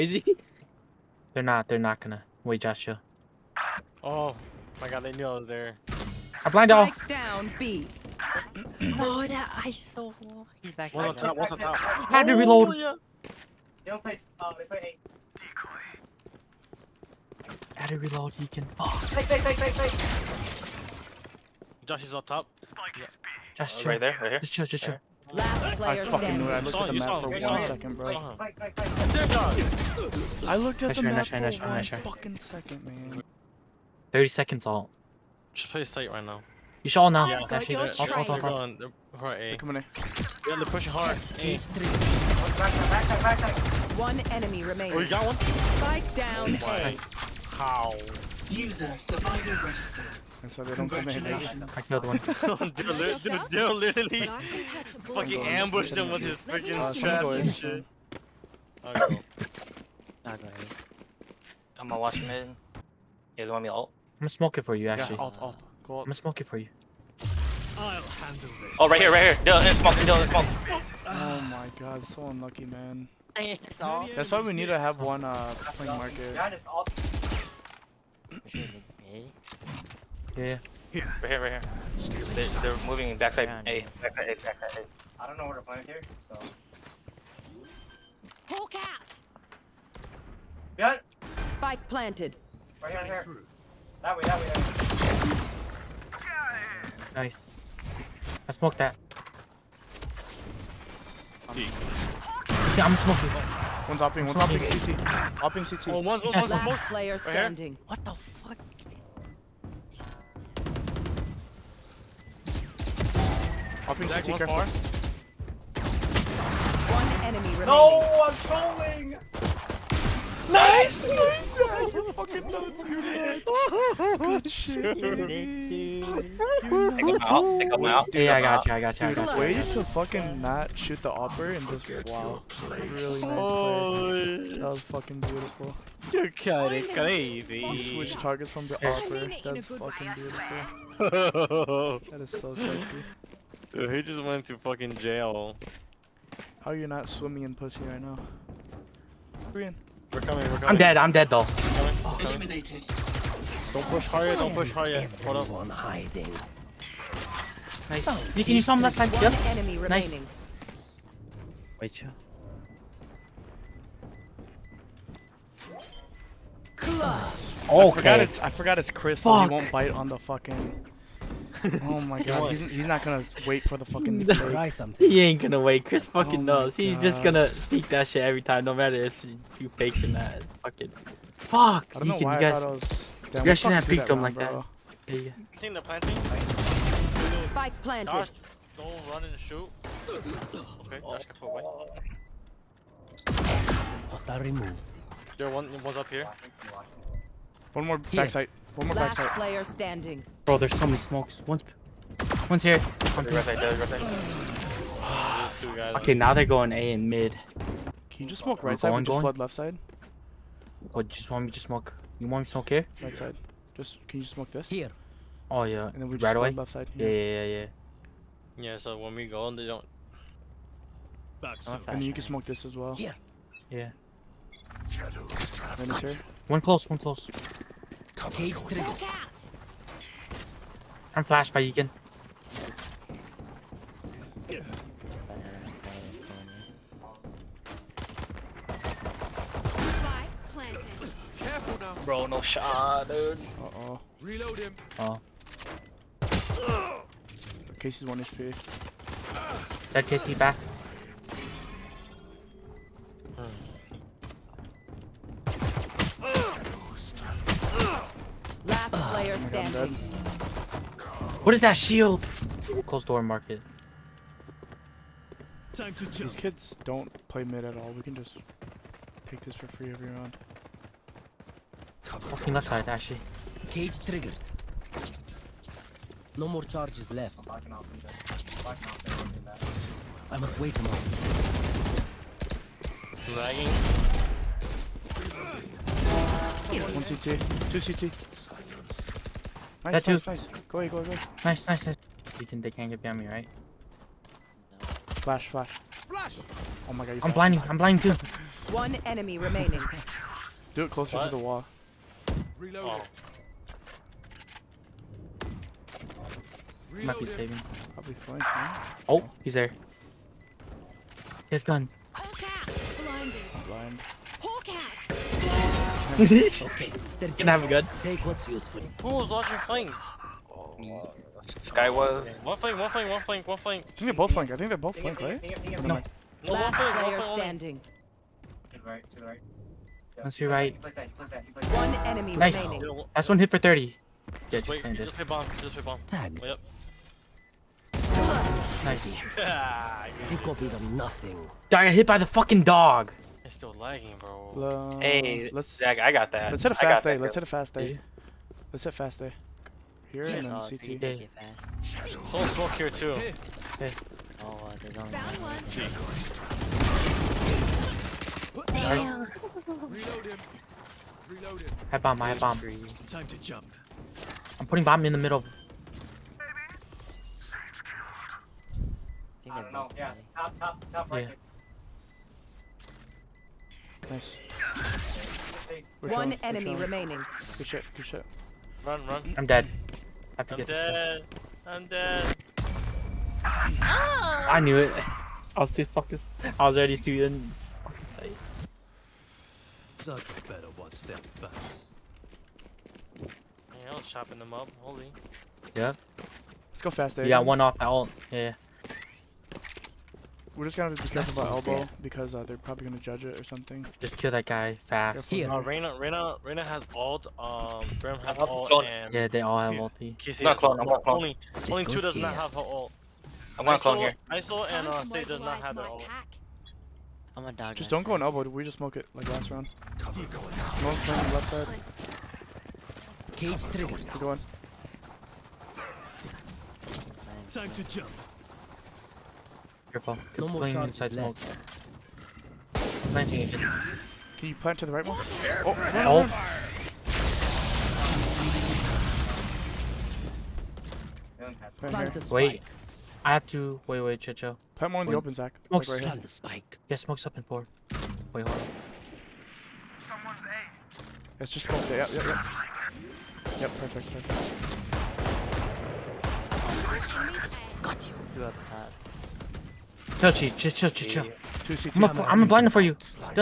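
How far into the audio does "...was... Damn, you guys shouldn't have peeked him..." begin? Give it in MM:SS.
03:02.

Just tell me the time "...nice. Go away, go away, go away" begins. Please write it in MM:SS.
04:50.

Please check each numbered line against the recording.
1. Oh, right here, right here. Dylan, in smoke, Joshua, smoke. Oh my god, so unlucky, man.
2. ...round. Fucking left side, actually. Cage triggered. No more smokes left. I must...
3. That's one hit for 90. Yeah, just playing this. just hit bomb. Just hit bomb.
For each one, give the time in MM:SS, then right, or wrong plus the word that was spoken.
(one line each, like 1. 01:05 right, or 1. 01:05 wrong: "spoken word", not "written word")
1. 01:08 wrong: "Dylan", not "Joshua"
2. 04:30 wrong: "charges", not "smokes"
3. 05:33 wrong: "30", not "90".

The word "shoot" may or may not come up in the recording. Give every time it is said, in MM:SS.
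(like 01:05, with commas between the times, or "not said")
02:10, 03:09.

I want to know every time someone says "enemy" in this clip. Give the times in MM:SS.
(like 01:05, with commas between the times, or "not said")
00:44, 01:57, 02:39, 04:59, 05:32, 06:16.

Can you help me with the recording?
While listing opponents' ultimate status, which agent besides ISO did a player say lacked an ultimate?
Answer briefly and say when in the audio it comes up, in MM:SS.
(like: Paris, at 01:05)
Sage, at 06:55.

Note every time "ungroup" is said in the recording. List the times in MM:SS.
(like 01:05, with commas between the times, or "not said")
not said.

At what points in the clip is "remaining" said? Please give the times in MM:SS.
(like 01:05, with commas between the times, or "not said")
00:44, 01:57, 02:39, 04:59, 05:32, 06:16.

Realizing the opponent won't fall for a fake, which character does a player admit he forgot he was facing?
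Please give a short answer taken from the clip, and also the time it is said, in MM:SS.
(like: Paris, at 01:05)
Crystal, at 02:48.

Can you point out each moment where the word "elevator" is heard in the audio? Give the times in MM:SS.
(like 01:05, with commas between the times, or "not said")
not said.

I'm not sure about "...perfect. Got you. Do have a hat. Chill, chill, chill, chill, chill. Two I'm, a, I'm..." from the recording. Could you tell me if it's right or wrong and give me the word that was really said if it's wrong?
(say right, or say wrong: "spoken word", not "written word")
right.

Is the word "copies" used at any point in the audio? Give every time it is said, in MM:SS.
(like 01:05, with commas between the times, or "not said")
05:40.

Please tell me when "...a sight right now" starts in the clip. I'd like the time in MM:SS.
00:35.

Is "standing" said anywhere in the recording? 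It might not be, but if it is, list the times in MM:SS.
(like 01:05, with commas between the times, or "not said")
01:47, 03:19, 04:19, 05:27.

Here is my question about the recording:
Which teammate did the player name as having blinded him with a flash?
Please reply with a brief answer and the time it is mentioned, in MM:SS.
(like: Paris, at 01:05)
Egan, at 03:51.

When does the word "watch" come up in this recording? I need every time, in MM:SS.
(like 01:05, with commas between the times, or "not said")
01:01, 06:30.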